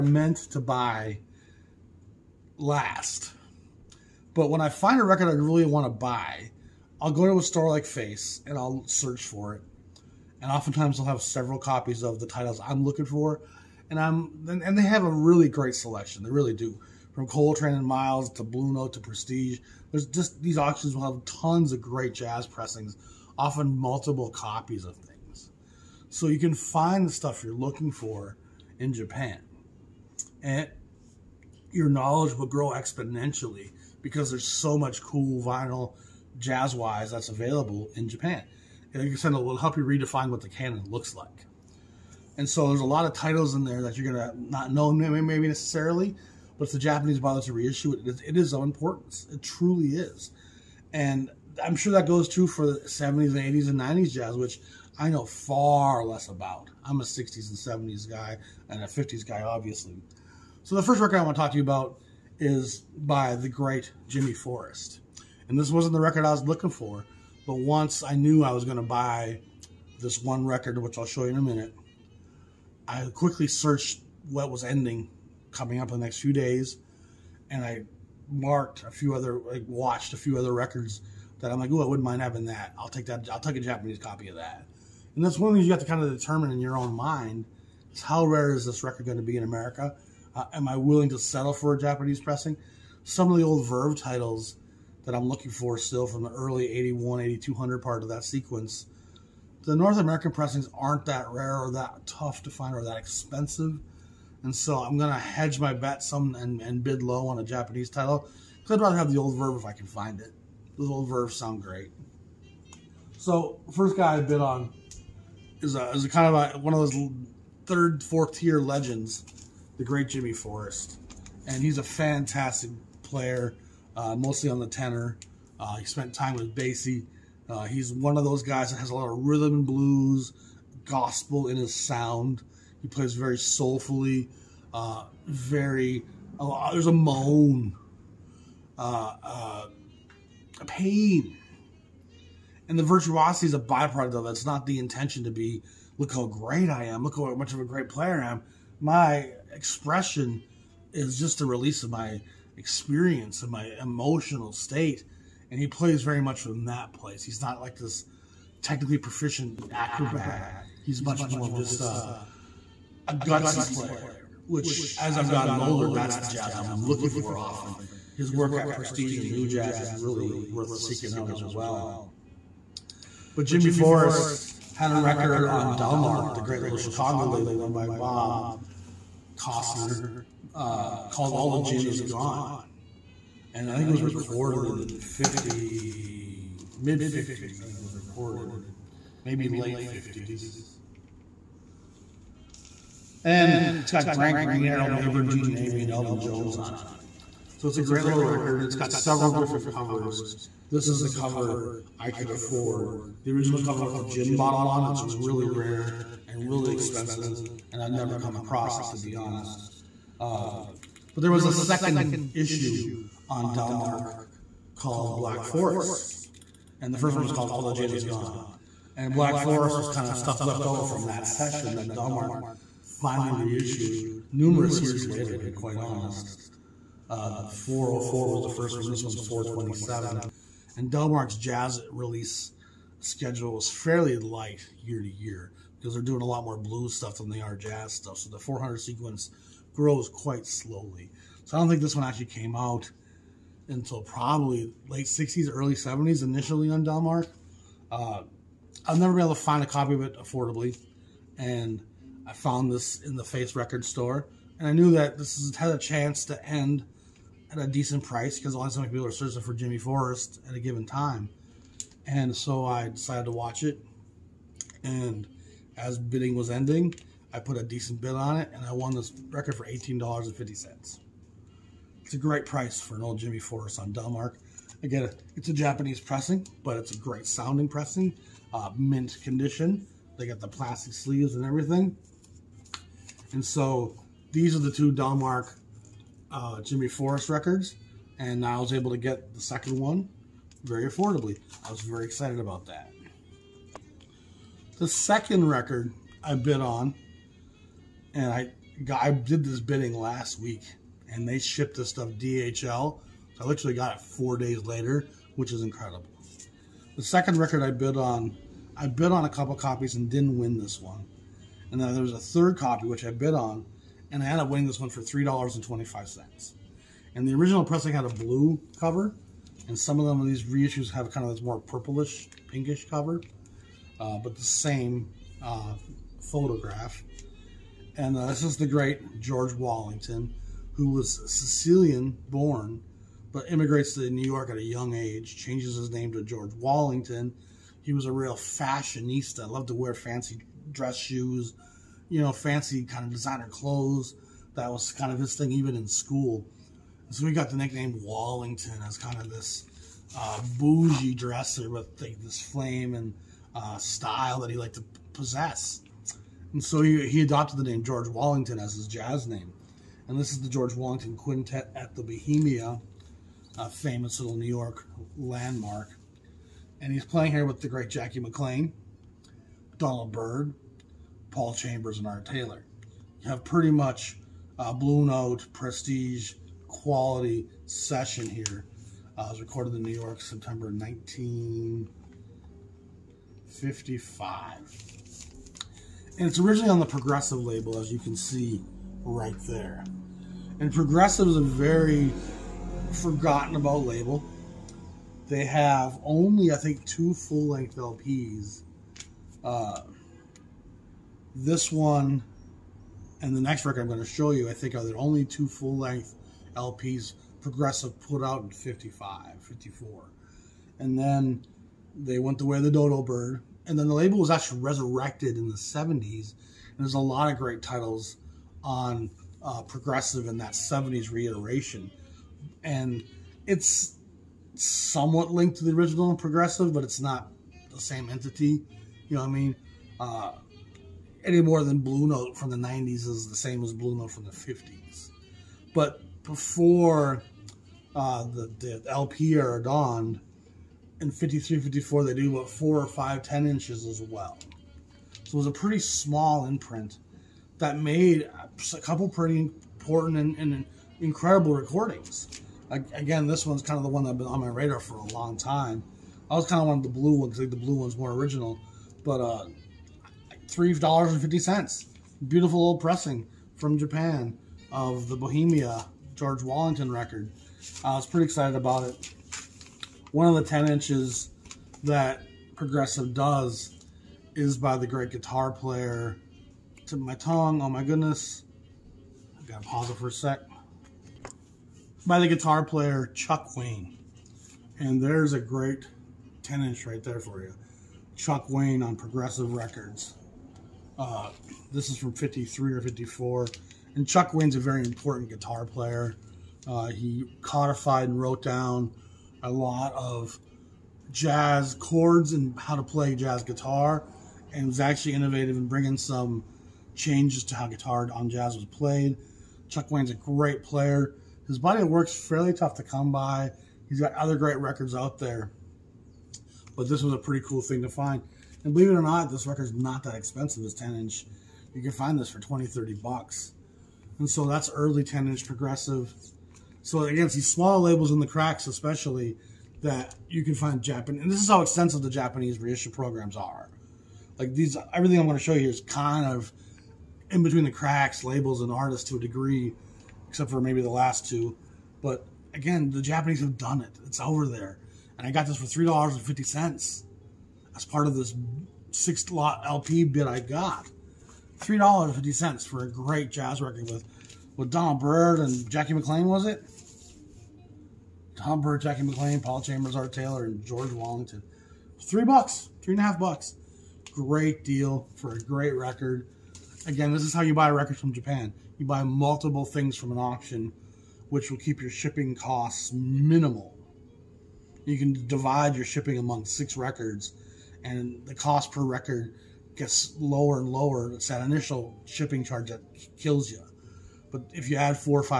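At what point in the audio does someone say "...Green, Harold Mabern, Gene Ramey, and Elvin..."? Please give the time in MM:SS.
03:14.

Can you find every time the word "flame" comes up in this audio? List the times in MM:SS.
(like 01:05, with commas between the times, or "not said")
05:52.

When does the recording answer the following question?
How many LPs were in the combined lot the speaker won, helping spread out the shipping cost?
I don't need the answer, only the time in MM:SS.
09:08.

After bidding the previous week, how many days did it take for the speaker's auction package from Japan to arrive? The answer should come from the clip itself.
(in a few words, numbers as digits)
4 days.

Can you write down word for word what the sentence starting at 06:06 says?
And he's playing here with the great Jackie McLean, Donald Byrd, Paul Chambers, and Art Taylor.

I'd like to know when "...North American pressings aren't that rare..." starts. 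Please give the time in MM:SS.
01:39.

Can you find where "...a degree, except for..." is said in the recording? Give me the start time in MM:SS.
08:59.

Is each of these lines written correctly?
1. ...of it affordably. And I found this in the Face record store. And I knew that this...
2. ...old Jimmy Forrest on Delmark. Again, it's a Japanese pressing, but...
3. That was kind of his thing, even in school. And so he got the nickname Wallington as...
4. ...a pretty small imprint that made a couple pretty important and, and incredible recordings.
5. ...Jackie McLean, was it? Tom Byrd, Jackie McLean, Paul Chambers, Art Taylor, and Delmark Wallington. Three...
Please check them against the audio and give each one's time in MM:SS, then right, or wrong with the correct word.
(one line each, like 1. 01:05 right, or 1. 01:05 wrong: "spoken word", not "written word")
1. 04:09 right
2. 04:33 right
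3. 05:44 right
4. 07:25 right
5. 09:15 wrong: "George", not "Delmark".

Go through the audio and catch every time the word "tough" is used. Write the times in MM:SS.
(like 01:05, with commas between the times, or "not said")
01:42, 08:32.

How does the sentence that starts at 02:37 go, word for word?
He's not like this technically proficient acrobat.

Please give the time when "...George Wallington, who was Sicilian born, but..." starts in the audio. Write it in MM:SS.
05:29.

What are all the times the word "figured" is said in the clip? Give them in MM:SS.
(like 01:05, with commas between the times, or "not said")
not said.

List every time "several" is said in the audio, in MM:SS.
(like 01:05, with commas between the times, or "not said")
00:11, 03:18.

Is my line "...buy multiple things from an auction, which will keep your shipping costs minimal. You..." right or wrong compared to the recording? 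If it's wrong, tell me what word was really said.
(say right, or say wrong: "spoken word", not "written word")
right.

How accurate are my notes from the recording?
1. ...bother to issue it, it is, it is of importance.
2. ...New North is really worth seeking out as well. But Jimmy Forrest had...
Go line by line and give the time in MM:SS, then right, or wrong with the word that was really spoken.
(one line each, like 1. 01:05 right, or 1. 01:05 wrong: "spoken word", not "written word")
1. 00:47 wrong: "reissue", not "issue"
2. 02:49 wrong: "Jazz", not "North".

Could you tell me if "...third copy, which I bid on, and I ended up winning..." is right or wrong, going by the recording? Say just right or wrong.
right.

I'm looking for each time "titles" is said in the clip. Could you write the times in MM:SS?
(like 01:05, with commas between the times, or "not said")
00:12, 00:43, 01:34, 01:47, 06:57.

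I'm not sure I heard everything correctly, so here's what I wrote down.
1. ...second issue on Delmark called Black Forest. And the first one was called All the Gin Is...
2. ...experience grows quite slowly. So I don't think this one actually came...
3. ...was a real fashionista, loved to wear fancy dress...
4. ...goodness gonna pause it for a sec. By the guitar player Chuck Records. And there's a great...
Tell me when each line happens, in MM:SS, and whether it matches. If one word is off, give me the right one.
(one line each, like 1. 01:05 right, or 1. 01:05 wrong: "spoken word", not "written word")
1. 03:31 right
2. 03:58 wrong: "sequence", not "experience"
3. 05:37 right
4. 07:57 wrong: "Wayne", not "Records".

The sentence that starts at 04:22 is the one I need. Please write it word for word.
And so I decided to watch it.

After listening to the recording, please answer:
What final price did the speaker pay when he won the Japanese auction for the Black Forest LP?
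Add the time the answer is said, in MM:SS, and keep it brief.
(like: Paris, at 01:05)
$18.50, at 04:29.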